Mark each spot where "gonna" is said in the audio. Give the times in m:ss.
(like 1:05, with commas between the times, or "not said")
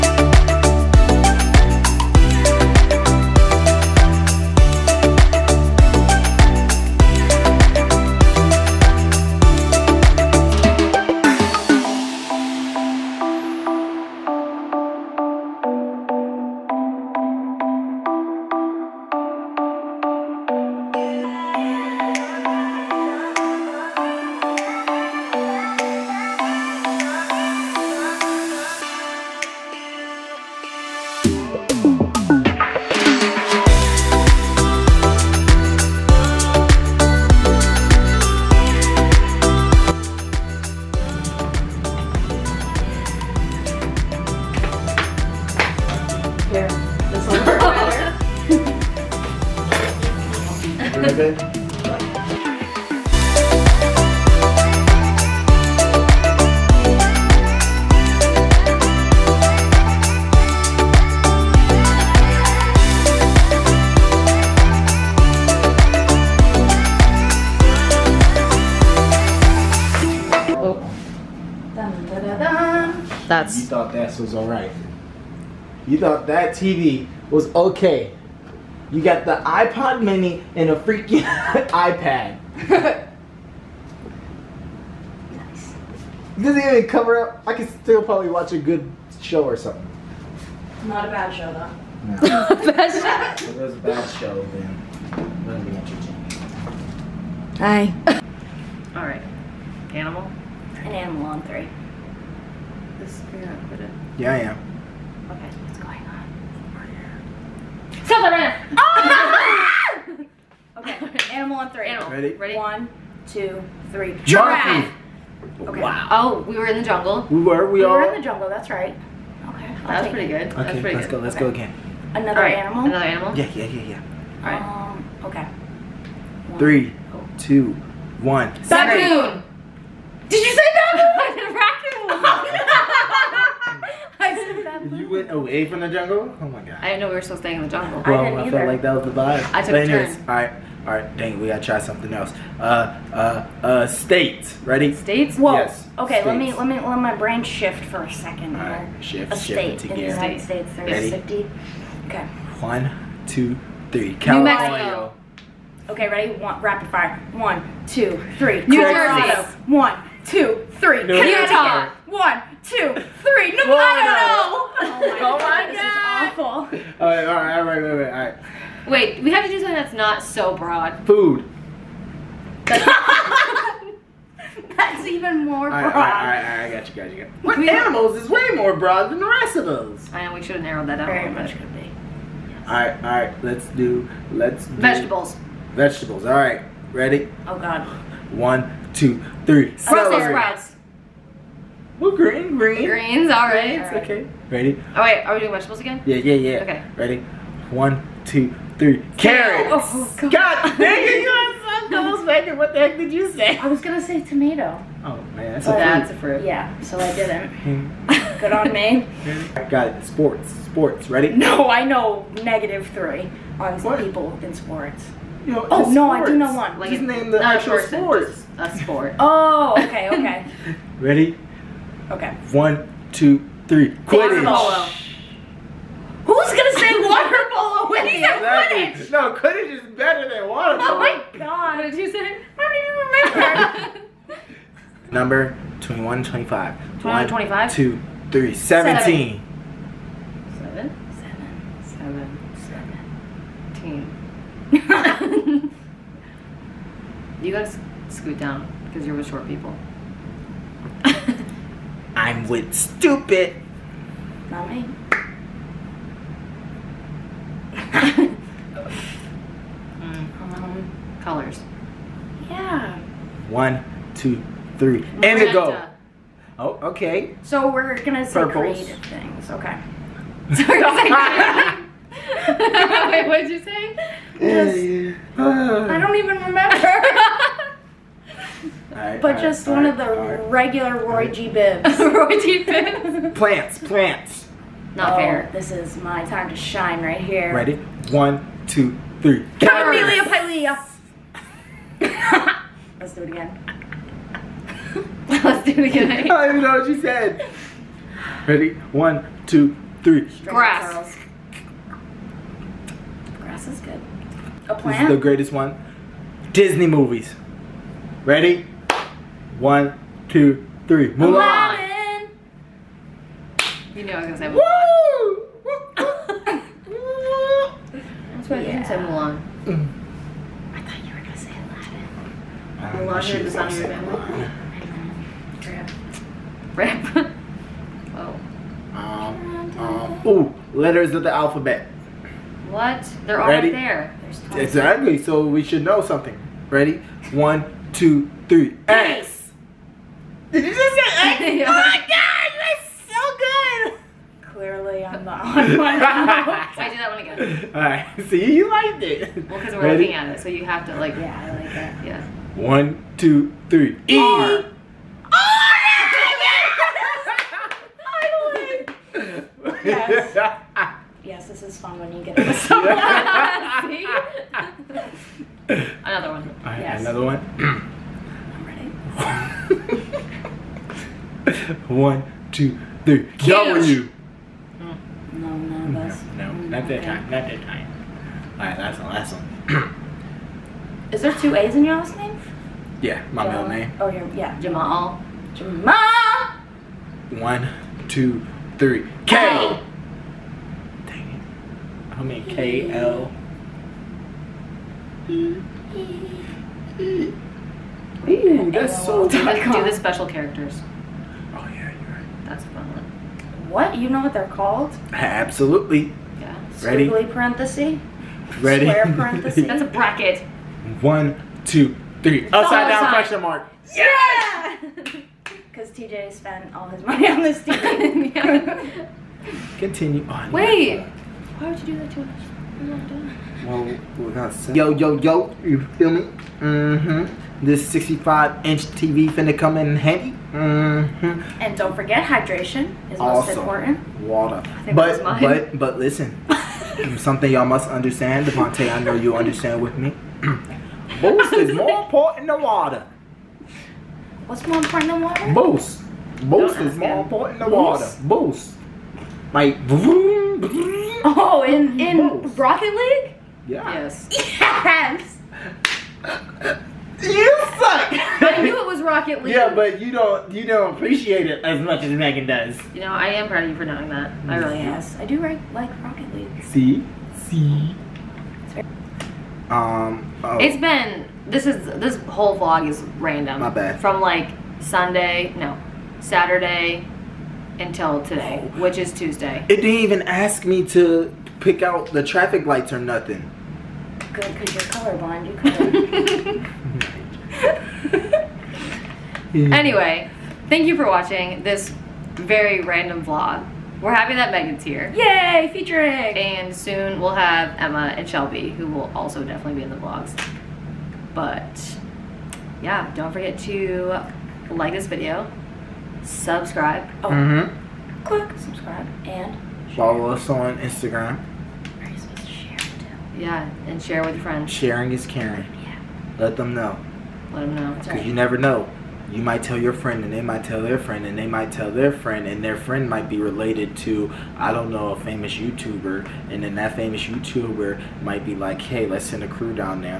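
1:43, 3:23, 4:28, 5:14.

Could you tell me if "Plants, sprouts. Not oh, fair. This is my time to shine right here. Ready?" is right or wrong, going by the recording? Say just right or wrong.
wrong.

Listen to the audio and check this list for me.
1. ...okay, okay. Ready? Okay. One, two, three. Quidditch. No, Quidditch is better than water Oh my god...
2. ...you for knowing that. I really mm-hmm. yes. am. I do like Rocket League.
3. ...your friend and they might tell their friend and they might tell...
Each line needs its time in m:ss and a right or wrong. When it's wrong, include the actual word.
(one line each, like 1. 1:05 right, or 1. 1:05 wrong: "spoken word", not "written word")
1. 3:39 right
2. 7:43 right
3. 8:39 right.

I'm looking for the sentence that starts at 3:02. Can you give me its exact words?
Alright, alright, let's do, let's do.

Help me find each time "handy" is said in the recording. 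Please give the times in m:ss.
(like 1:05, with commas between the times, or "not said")
7:09.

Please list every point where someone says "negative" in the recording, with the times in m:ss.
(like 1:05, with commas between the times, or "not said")
3:32.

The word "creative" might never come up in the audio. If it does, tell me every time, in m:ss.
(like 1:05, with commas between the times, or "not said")
4:28.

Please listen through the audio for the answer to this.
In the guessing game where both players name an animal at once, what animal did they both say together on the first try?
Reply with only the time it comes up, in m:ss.
1:54.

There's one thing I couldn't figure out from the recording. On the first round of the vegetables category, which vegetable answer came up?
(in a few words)
Brussels sprouts.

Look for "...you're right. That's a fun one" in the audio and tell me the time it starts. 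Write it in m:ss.
6:41.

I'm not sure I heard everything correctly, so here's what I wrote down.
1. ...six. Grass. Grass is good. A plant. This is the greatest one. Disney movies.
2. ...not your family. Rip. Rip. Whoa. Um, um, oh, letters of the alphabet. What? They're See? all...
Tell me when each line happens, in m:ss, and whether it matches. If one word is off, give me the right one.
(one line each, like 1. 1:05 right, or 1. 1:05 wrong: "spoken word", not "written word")
1. 5:00 wrong: "three", not "six"
2. 5:23 wrong: "Ready", not "See".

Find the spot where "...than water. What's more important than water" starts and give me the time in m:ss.
7:22.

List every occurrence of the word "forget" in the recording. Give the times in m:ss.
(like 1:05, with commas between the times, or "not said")
7:11, 8:23.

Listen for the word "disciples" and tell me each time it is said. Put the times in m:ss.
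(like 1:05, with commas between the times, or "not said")
not said.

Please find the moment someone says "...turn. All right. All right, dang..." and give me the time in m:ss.
2:20.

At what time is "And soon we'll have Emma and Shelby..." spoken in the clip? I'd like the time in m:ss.
8:16.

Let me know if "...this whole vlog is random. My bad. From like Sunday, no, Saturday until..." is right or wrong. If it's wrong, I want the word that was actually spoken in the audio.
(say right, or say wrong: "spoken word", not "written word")
right.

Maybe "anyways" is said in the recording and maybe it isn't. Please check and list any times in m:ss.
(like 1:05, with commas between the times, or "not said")
2:19, 8:09.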